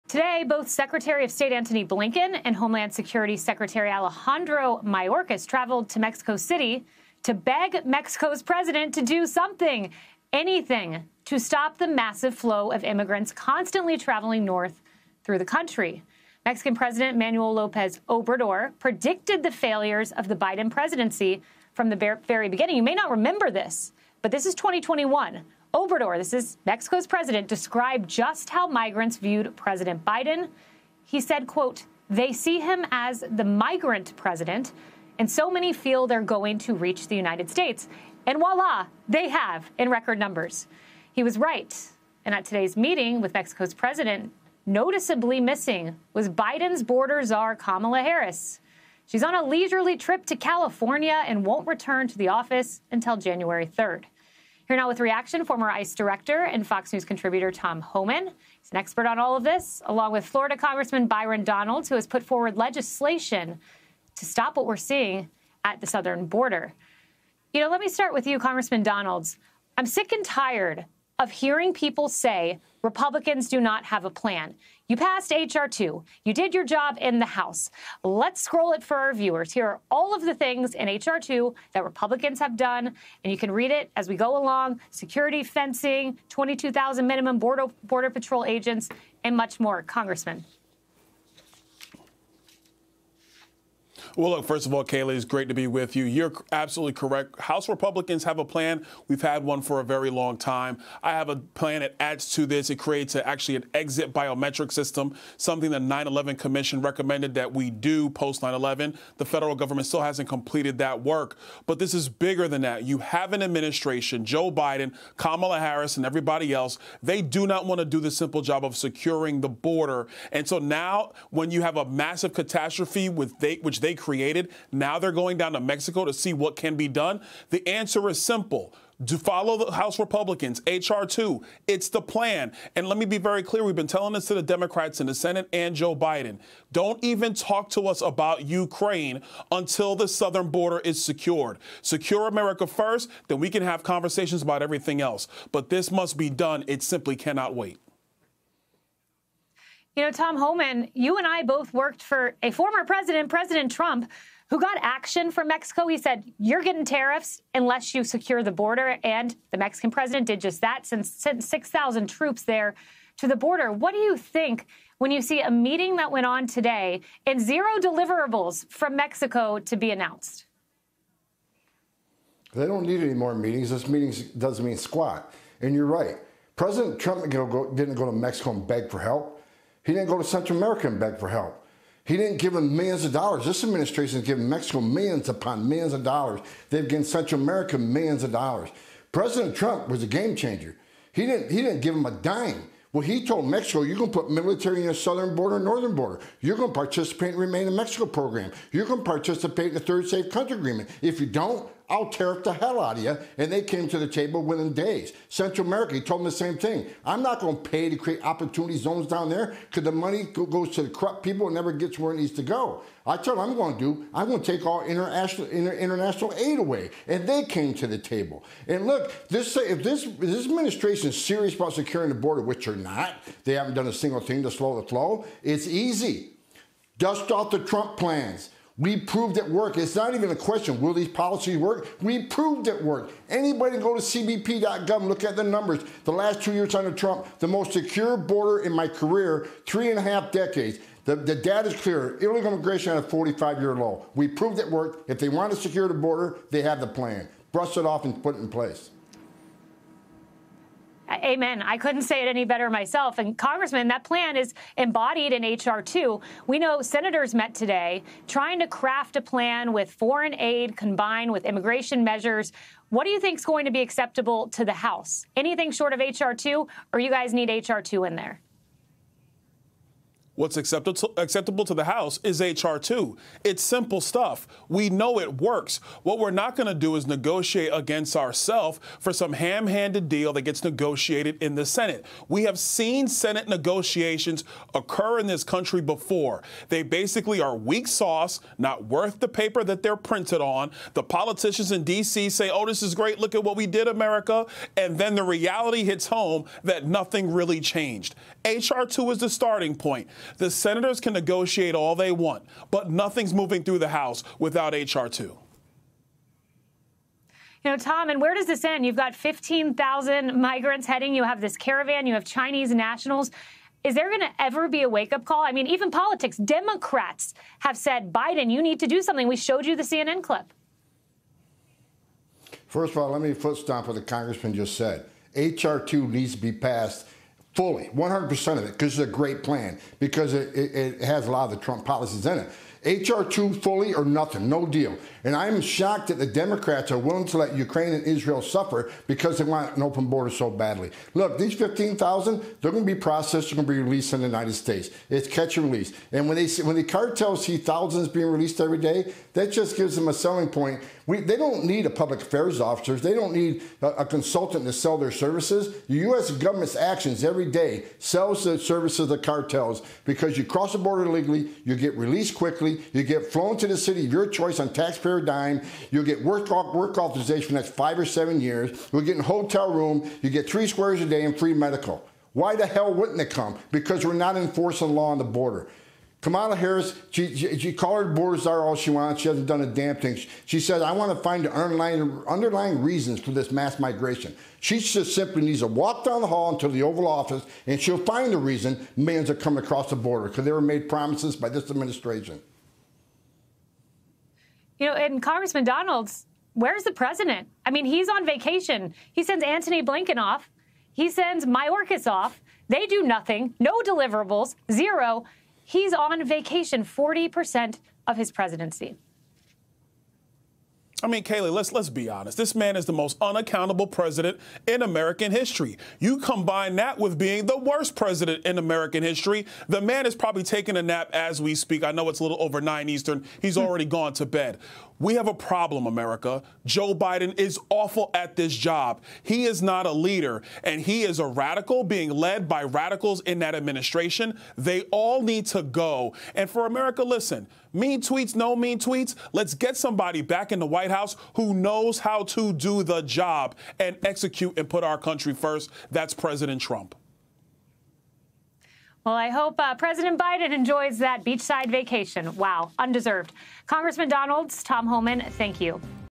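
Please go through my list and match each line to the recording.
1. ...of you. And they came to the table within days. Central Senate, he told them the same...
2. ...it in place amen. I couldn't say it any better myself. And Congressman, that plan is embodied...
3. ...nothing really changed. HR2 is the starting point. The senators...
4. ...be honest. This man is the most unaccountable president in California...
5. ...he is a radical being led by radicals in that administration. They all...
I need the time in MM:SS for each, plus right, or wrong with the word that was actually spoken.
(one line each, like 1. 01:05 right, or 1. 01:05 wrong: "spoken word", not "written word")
1. 03:22 wrong: "America", not "Senate"
2. 04:08 right
3. 04:56 right
4. 06:51 wrong: "American", not "California"
5. 07:10 right.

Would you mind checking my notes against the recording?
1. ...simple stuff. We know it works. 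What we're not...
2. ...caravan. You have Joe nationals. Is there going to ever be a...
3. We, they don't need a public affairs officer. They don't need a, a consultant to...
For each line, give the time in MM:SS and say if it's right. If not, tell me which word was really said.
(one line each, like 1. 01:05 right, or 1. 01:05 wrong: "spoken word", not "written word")
1. 04:33 right
2. 05:11 wrong: "Chinese", not "Joe"
3. 05:51 right.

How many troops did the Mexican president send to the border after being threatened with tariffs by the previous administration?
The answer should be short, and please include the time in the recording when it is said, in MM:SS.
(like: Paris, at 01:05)
6,000, at 02:41.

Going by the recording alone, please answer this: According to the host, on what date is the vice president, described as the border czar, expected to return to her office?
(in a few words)
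January 3rd.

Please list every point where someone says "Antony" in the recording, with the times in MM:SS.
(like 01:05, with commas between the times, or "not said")
00:01, 06:39.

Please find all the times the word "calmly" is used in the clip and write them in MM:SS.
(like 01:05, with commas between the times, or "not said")
not said.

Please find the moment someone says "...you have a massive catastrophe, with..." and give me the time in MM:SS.
02:01.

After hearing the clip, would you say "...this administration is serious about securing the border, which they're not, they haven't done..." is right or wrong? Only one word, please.
right.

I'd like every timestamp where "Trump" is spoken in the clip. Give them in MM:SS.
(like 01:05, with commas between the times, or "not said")
02:33, 02:56, 03:09, 03:47, 03:56, 05:31, 07:26.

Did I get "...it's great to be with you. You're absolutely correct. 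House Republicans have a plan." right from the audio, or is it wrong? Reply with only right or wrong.
right.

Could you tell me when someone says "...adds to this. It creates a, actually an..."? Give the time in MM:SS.
01:41.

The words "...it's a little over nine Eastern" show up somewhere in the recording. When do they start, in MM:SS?
07:02.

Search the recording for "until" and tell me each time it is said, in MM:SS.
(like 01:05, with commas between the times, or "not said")
00:52, 02:19.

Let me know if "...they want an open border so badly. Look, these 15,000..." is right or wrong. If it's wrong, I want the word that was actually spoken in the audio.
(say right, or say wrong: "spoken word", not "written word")
right.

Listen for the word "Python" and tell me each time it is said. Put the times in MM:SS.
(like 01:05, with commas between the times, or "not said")
not said.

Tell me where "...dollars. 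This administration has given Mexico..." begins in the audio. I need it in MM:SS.
03:03.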